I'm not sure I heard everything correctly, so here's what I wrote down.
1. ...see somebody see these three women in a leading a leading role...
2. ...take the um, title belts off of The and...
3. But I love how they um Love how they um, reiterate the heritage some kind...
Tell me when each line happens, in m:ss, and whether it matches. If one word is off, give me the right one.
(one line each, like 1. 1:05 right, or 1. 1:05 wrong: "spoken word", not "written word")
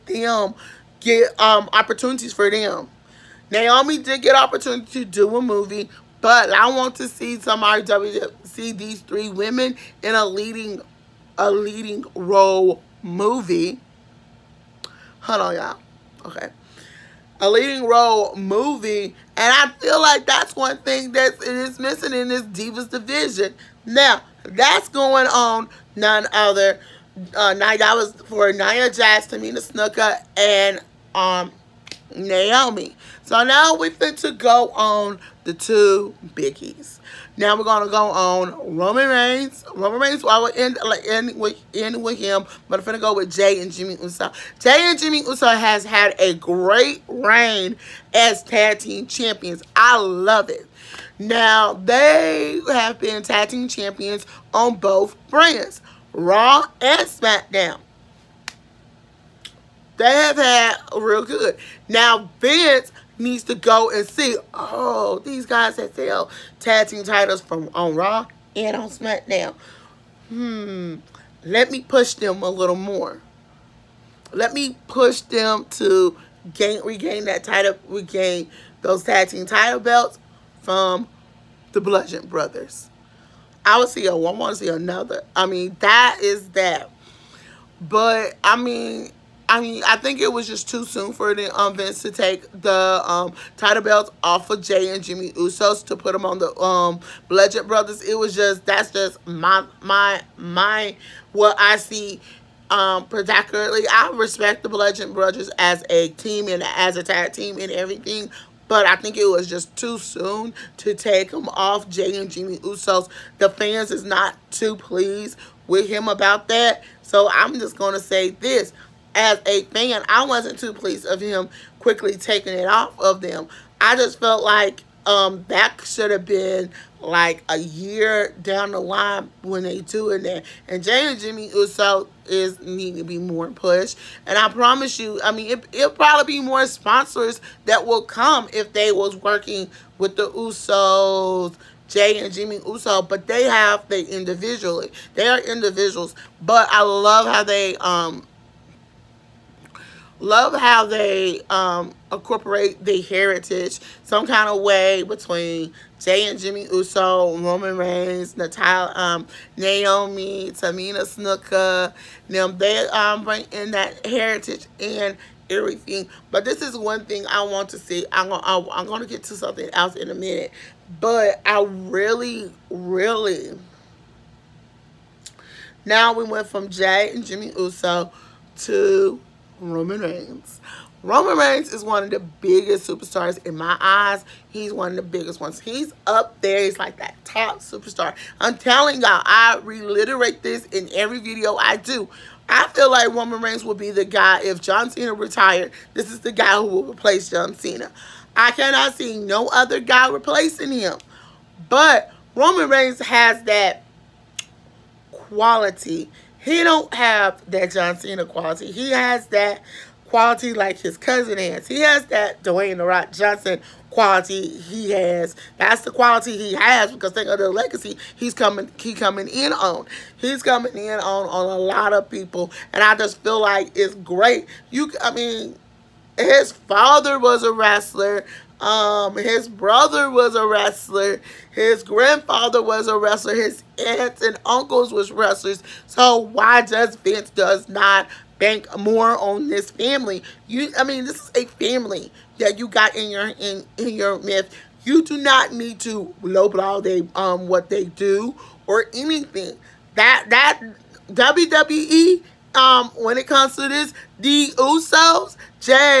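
1. 0:07 right
2. 1:32 wrong: "Jay", not "The"
3. 2:26 wrong: "incorporate", not "reiterate".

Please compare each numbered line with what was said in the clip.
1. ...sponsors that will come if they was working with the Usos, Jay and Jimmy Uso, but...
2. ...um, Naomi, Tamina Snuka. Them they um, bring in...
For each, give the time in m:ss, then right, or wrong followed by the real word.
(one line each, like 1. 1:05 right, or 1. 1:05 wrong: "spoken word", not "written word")
1. 2:16 right
2. 2:38 right.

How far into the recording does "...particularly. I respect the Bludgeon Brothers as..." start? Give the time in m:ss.
1:43.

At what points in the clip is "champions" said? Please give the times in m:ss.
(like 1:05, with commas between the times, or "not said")
0:49, 0:53.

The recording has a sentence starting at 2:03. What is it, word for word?
I just felt like um, that should have been like a year down the line when they doing that.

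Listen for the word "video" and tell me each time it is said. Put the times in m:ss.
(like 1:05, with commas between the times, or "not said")
3:11.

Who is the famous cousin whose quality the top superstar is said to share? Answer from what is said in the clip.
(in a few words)
Dwayne The Rock Johnson.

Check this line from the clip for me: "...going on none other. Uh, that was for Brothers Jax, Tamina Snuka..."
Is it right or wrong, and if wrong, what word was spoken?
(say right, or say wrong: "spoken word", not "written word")
wrong: "Nia", not "Brothers".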